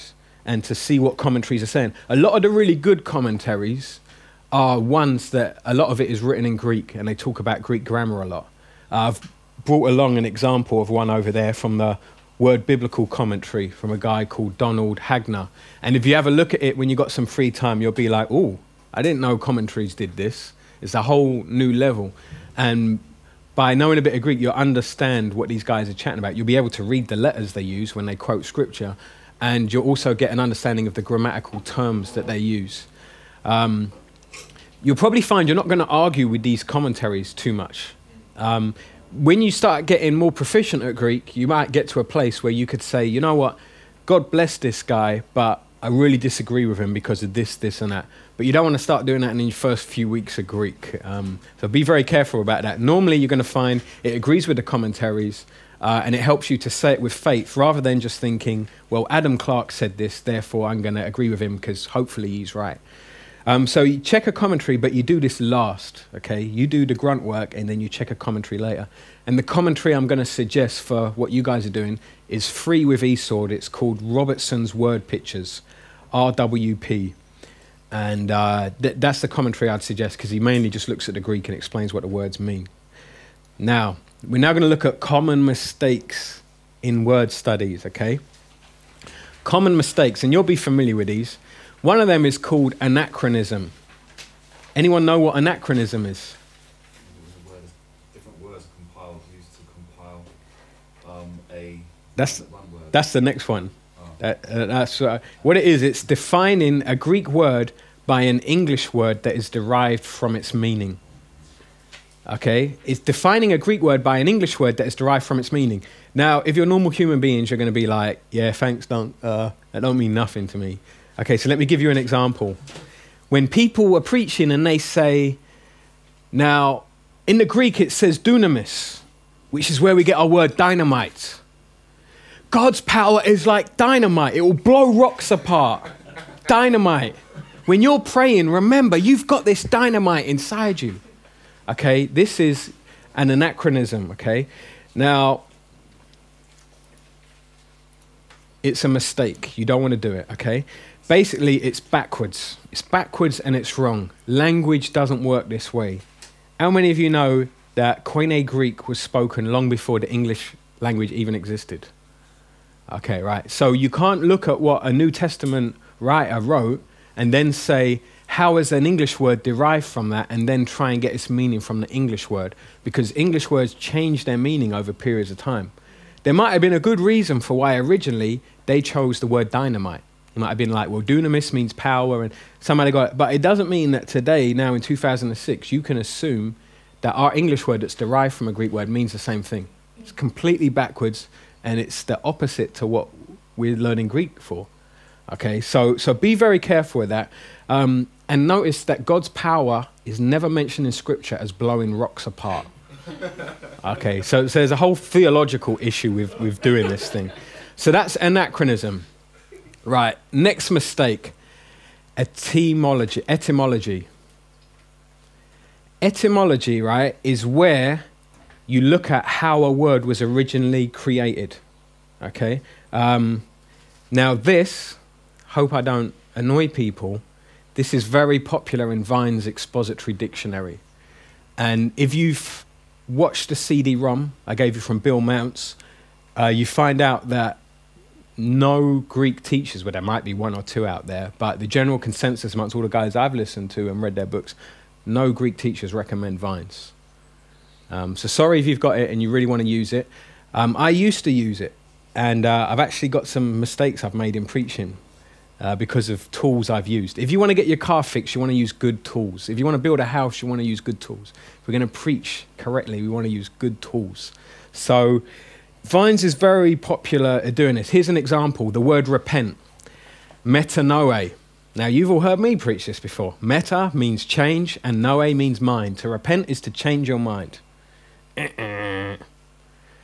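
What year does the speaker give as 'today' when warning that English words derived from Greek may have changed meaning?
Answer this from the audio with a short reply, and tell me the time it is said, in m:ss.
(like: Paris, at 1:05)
2006, at 3:04.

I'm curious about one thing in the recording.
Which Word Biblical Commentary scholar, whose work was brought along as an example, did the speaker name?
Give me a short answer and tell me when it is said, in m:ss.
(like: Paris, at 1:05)
Donald Hagner, at 0:14.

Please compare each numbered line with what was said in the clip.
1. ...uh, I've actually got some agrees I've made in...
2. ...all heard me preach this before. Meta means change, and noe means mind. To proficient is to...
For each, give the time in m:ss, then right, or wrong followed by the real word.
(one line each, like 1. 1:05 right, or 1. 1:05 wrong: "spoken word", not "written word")
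1. 4:12 wrong: "mistakes", not "agrees"
2. 4:32 wrong: "repent", not "proficient".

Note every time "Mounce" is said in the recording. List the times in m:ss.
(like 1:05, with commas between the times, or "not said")
3:55.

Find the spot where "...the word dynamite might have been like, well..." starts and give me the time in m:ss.
2:59.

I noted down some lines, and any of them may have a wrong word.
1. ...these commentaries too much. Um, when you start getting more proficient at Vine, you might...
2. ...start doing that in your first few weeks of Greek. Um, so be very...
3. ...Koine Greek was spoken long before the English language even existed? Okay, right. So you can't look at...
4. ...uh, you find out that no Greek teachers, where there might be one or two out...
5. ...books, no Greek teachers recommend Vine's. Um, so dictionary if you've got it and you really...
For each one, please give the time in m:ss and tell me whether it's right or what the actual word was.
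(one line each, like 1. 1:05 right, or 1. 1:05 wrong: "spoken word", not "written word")
1. 0:36 wrong: "Greek", not "Vine"
2. 0:48 right
3. 2:38 right
4. 3:56 right
5. 4:04 wrong: "sorry", not "dictionary".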